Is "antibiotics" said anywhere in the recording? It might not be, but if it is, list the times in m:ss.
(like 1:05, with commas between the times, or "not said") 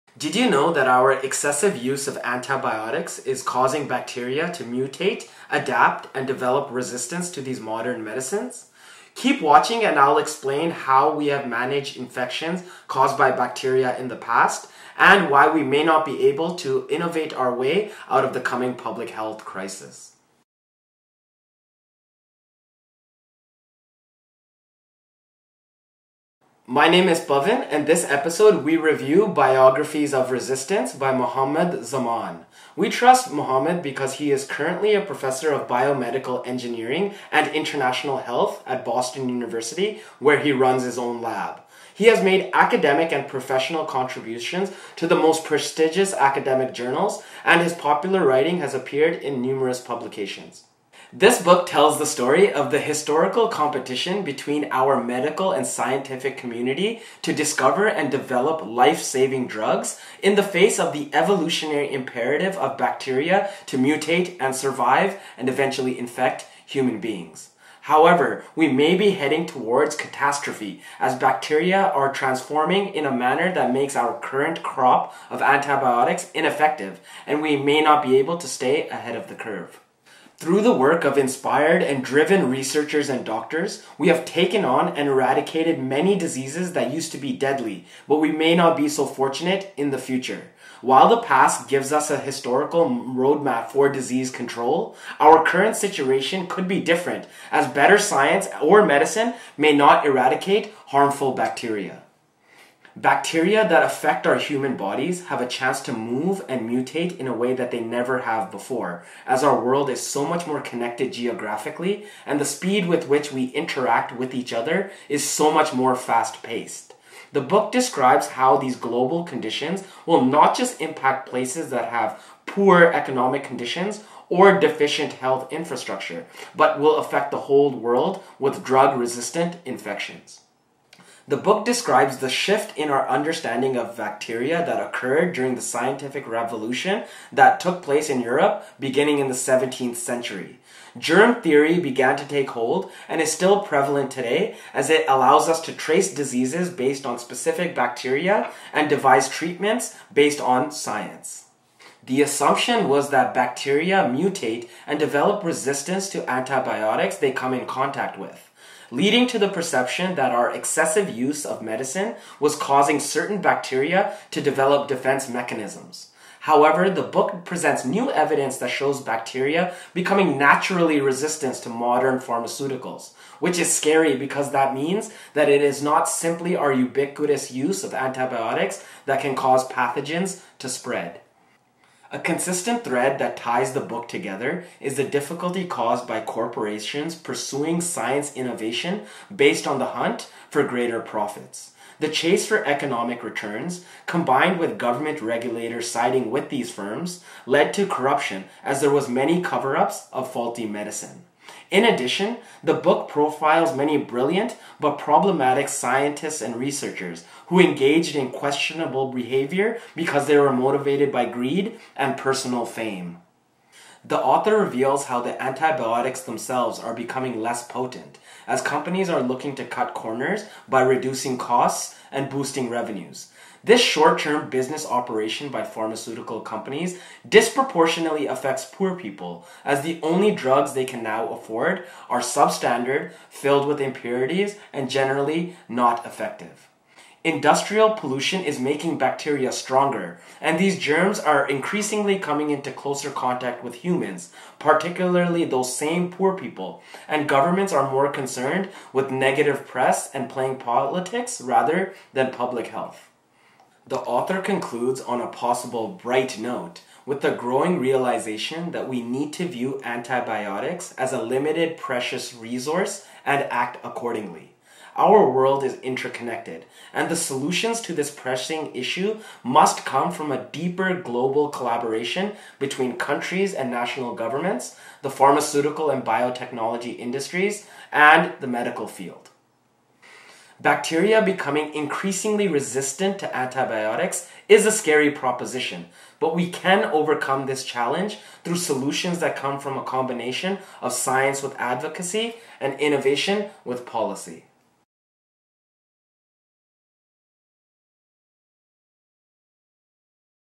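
0:02, 1:15, 2:36, 2:57, 3:35, 4:19, 4:43.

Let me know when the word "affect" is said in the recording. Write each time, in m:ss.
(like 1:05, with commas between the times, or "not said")
1:43, 2:06, 3:48.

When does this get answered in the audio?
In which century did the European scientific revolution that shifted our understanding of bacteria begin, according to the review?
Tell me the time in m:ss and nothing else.
2:19.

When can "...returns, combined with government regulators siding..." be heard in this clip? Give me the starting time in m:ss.
3:13.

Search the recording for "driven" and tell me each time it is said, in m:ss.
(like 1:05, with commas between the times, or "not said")
1:22.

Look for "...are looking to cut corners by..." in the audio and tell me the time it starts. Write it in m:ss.
3:39.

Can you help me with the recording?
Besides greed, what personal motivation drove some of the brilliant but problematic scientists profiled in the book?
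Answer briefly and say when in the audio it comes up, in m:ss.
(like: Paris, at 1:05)
personal fame, at 3:32.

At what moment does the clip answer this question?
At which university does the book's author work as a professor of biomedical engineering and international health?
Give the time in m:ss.
0:38.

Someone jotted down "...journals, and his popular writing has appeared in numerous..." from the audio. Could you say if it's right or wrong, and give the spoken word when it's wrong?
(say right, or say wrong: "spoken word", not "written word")
right.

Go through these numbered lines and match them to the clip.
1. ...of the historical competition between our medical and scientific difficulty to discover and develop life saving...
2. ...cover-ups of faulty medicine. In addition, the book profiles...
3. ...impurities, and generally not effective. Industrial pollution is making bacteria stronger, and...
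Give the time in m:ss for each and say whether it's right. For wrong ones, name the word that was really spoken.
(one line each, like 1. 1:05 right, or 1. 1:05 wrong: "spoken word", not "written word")
1. 0:52 wrong: "community", not "difficulty"
2. 3:19 right
3. 3:53 right.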